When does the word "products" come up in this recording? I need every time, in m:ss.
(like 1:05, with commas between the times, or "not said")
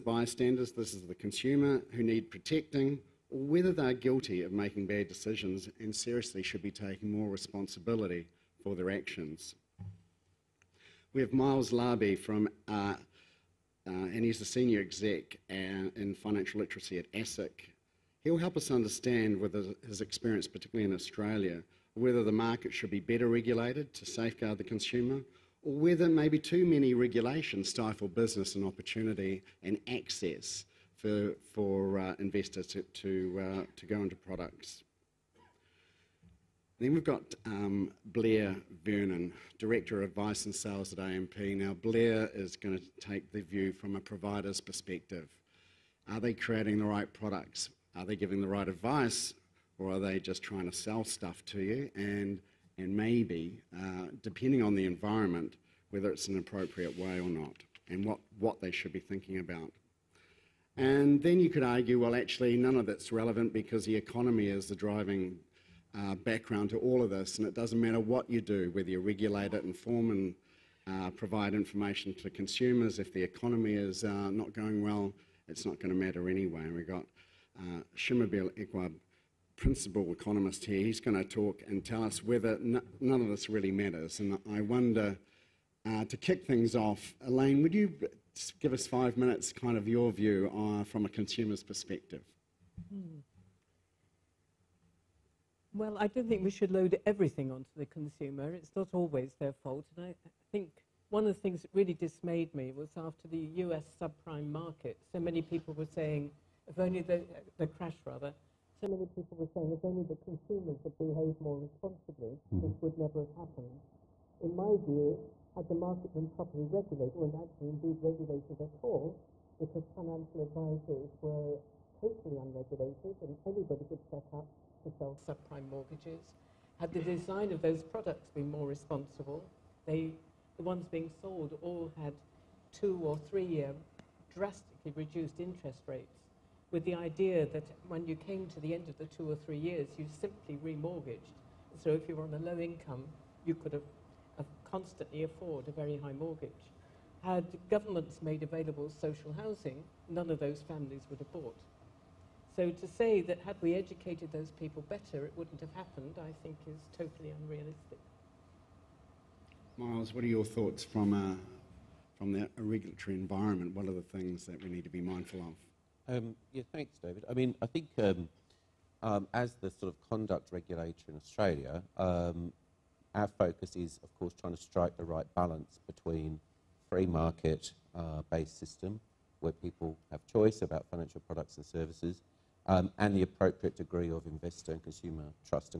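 0:34, 0:47, 2:07, 3:01.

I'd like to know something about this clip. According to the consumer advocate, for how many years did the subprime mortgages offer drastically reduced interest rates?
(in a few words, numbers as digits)
2 or 3 years.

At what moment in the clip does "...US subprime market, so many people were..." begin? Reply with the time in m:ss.
1:43.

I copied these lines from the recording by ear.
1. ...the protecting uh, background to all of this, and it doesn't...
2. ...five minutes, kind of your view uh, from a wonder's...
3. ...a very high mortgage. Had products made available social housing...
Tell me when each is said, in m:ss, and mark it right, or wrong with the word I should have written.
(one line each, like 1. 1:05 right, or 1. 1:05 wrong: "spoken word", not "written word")
1. 1:04 wrong: "driving", not "protecting"
2. 1:28 wrong: "consumer", not "wonder"
3. 2:25 wrong: "governments", not "products".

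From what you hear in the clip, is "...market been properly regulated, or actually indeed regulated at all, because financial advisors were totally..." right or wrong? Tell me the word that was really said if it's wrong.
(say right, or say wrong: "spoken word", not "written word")
right.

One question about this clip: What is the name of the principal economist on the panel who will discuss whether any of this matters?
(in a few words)
Shamubeel Eaqub.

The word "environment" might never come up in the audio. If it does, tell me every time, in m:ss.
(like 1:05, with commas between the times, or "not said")
0:54, 2:43.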